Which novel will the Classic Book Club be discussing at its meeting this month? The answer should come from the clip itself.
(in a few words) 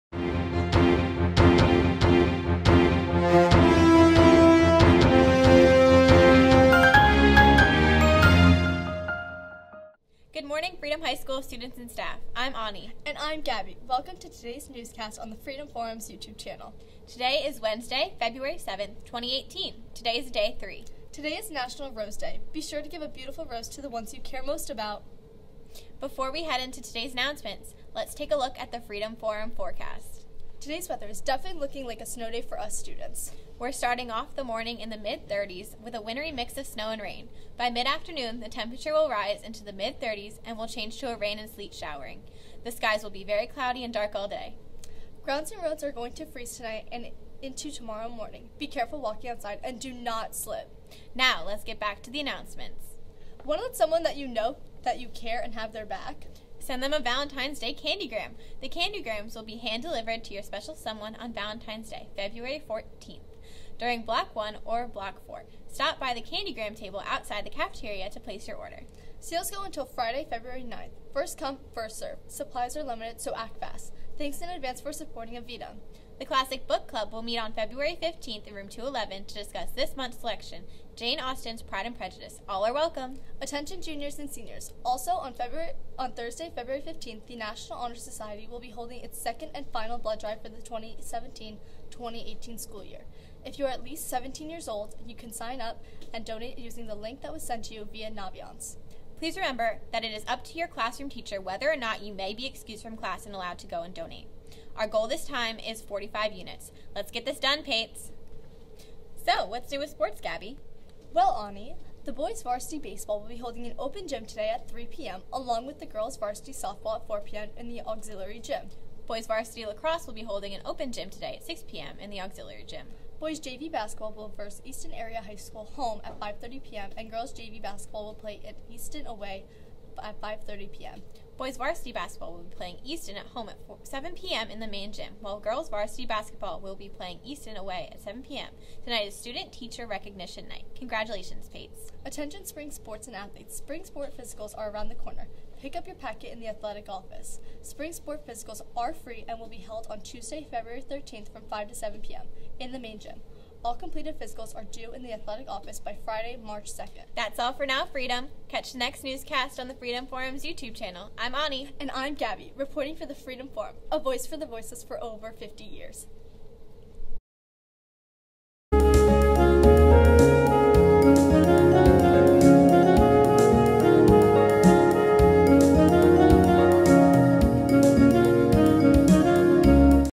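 Pride and Prejudice.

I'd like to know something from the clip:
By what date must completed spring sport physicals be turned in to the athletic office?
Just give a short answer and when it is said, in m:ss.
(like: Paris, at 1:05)
Friday, March 2nd, at 2:36.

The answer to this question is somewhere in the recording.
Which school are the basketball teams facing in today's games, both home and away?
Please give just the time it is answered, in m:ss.
2:04.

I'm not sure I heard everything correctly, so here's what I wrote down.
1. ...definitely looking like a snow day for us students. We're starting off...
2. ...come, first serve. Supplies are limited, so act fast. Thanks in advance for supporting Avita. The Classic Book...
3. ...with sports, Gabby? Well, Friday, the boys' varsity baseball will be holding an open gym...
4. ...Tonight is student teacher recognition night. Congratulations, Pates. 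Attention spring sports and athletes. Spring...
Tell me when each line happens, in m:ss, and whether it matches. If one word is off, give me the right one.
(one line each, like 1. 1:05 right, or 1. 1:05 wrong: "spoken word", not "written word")
1. 0:31 right
2. 1:11 right
3. 1:49 wrong: "Ani", not "Friday"
4. 2:18 right.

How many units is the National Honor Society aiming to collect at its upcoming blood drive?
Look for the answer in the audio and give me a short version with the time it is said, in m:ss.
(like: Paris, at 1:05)
45, at 1:45.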